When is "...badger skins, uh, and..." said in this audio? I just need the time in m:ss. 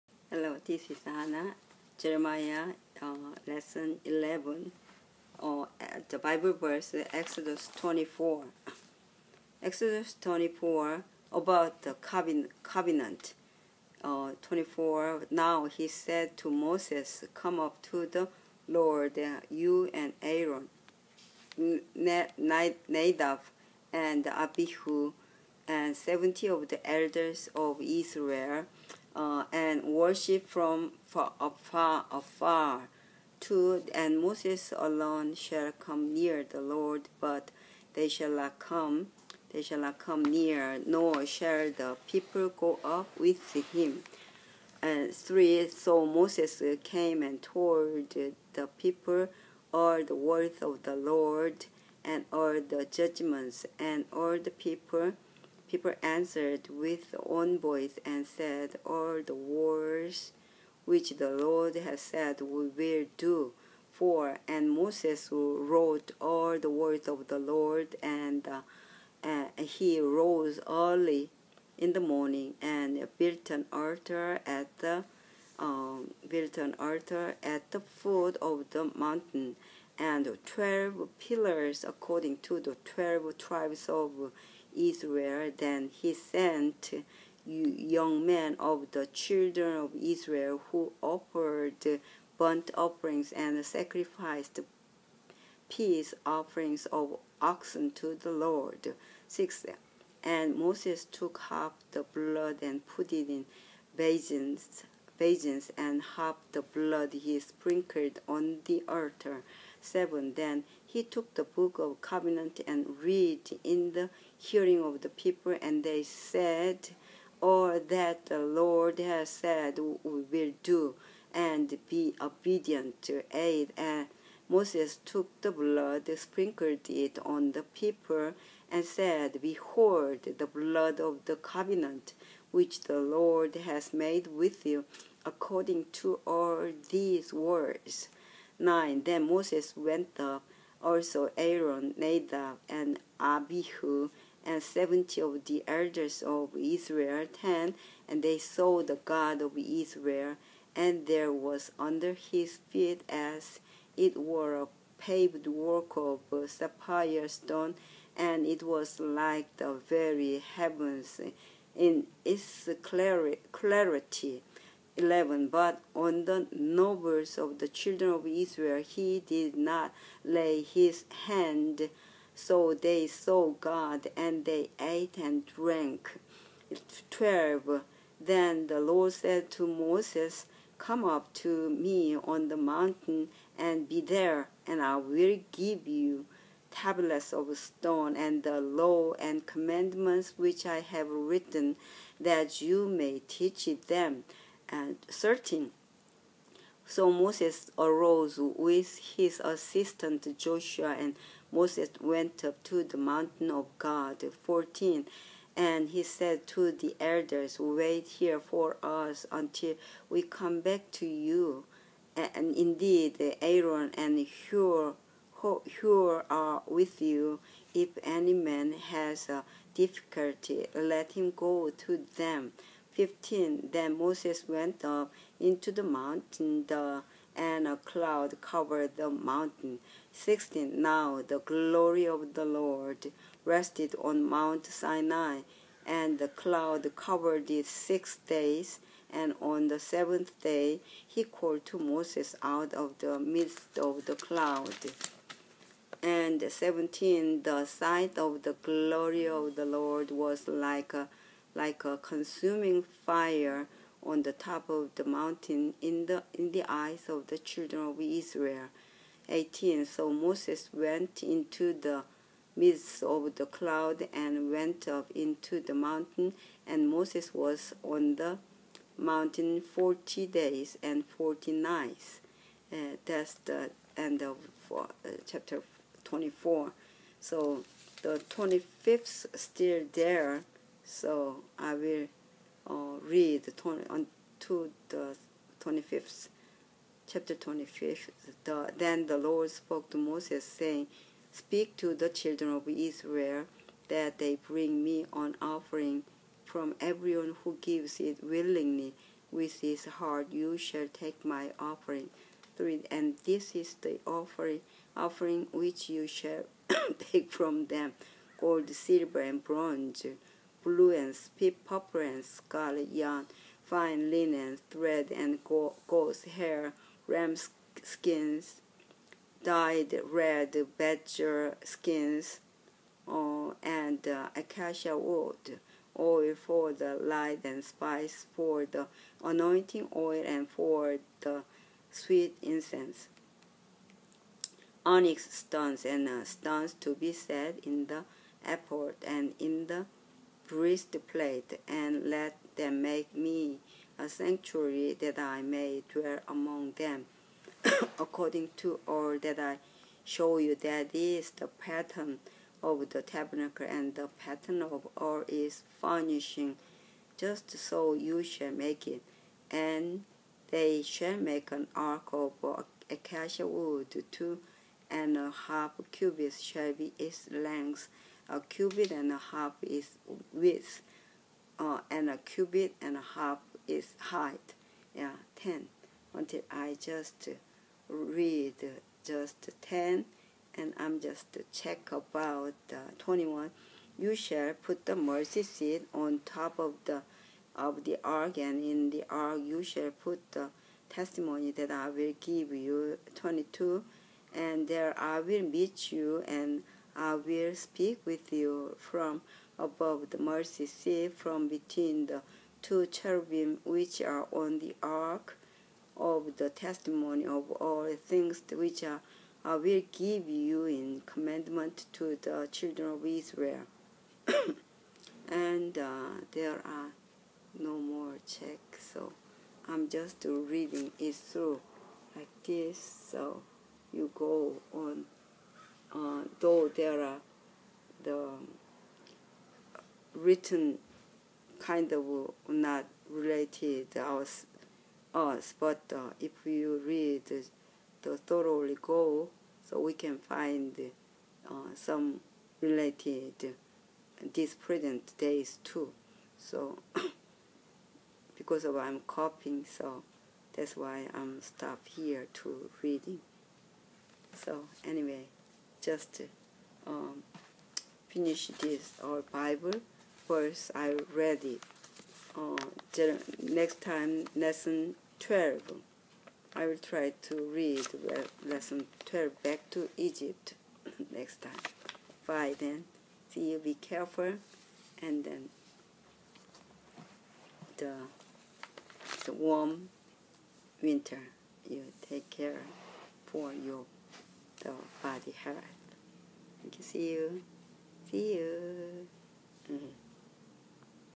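5:20.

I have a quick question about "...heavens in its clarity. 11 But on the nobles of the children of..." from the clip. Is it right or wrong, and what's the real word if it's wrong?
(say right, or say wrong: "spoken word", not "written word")
right.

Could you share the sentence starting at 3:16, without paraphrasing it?
So Moses arose with his assistant Joshua, and Moses went up to the mountain of God.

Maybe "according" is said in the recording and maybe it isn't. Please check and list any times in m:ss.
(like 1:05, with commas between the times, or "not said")
1:21, 2:15, 5:47.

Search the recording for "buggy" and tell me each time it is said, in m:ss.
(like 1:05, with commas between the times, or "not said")
not said.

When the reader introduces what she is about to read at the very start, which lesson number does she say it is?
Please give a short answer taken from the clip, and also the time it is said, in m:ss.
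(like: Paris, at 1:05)
11, at 0:03.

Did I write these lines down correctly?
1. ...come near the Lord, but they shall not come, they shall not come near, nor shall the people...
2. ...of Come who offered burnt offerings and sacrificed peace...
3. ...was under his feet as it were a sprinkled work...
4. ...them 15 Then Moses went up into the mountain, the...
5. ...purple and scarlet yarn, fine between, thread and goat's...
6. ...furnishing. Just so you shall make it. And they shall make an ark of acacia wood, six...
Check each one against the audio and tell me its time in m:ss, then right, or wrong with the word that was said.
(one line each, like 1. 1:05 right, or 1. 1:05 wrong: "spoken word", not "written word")
1. 0:35 right
2. 1:29 wrong: "Israel", not "Come"
3. 2:31 wrong: "paved", not "sprinkled"
4. 3:42 right
5. 5:11 wrong: "linen", not "between"
6. 5:55 wrong: "two", not "six".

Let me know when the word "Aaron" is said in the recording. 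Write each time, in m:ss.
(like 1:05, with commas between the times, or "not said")
0:20, 2:21, 3:33.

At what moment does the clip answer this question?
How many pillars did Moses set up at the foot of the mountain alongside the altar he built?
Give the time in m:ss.
1:20.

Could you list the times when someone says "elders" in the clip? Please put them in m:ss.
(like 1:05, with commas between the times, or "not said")
0:26, 2:25, 3:26.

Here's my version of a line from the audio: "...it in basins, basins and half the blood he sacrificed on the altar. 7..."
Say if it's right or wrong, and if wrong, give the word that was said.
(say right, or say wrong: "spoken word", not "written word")
wrong: "sprinkled", not "sacrificed".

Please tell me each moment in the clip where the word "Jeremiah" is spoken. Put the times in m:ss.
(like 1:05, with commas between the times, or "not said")
0:01.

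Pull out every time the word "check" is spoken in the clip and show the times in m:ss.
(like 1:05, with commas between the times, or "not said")
6:21, 6:58.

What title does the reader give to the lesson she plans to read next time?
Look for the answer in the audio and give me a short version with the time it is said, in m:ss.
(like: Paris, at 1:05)
Back to Egypt, at 7:49.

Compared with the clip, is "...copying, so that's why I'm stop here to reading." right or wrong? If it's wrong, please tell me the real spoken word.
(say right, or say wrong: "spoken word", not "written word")
right.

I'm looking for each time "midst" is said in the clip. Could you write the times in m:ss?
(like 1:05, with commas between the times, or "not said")
4:03, 4:22.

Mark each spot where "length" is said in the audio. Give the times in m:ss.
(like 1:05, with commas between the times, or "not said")
6:07.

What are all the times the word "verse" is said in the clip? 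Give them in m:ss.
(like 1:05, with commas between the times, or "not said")
0:06, 7:40.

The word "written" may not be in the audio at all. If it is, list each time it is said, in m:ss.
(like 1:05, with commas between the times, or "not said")
3:11, 7:10.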